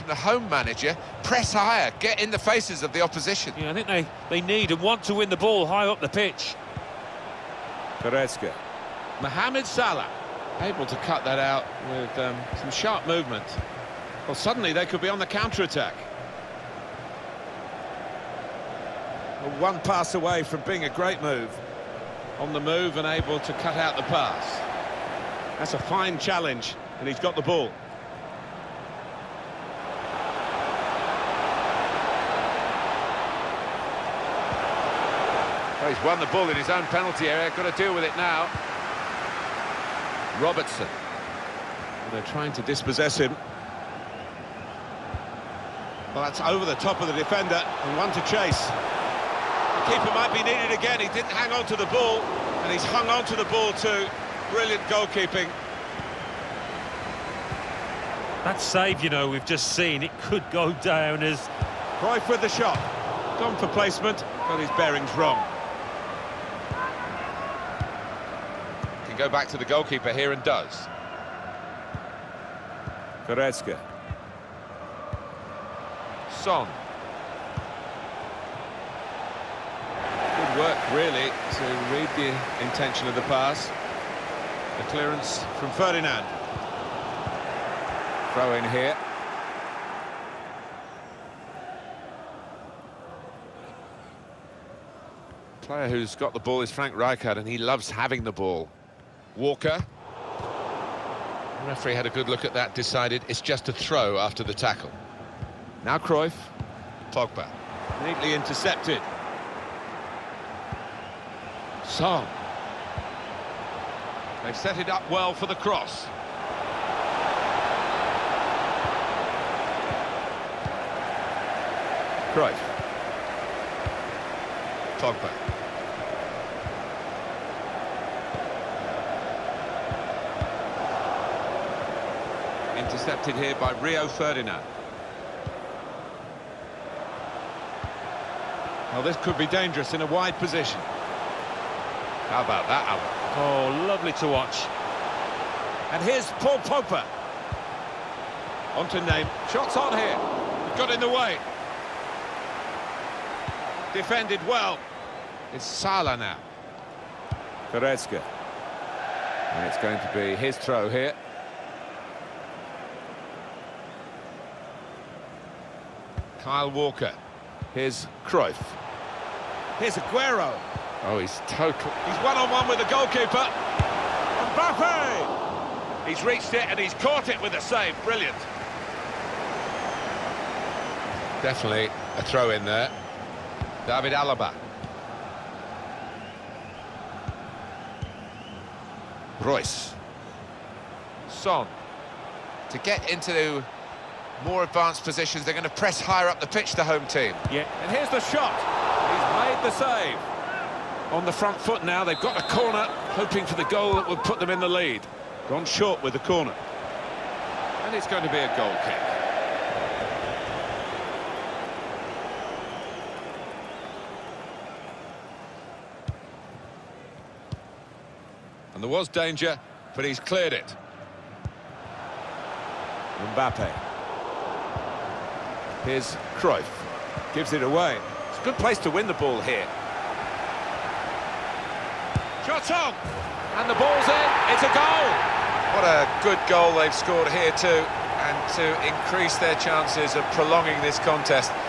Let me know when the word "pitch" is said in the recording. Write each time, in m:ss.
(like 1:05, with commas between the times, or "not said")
0:06, 3:16.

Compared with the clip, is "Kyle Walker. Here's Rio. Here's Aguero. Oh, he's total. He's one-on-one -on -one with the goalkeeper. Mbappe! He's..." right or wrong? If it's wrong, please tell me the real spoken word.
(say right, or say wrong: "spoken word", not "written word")
wrong: "Cruyff", not "Rio".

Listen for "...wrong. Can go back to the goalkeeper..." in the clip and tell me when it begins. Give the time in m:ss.
1:05.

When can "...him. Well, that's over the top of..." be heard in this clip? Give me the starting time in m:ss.
0:43.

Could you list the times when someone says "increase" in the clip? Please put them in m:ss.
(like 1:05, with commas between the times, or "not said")
3:58.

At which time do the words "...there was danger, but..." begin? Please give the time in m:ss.
3:38.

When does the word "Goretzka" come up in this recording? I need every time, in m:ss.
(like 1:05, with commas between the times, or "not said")
0:07, 1:13, 2:37.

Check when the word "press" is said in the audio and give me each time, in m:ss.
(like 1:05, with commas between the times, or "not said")
0:01, 3:15.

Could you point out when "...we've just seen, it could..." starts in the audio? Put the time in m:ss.
0:59.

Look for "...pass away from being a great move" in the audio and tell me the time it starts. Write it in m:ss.
0:19.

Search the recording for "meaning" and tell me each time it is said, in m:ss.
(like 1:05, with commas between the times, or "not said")
not said.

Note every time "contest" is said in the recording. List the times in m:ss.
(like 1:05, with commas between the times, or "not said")
4:00.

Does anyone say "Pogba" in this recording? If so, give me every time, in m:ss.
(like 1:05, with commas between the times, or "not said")
1:47, 2:26.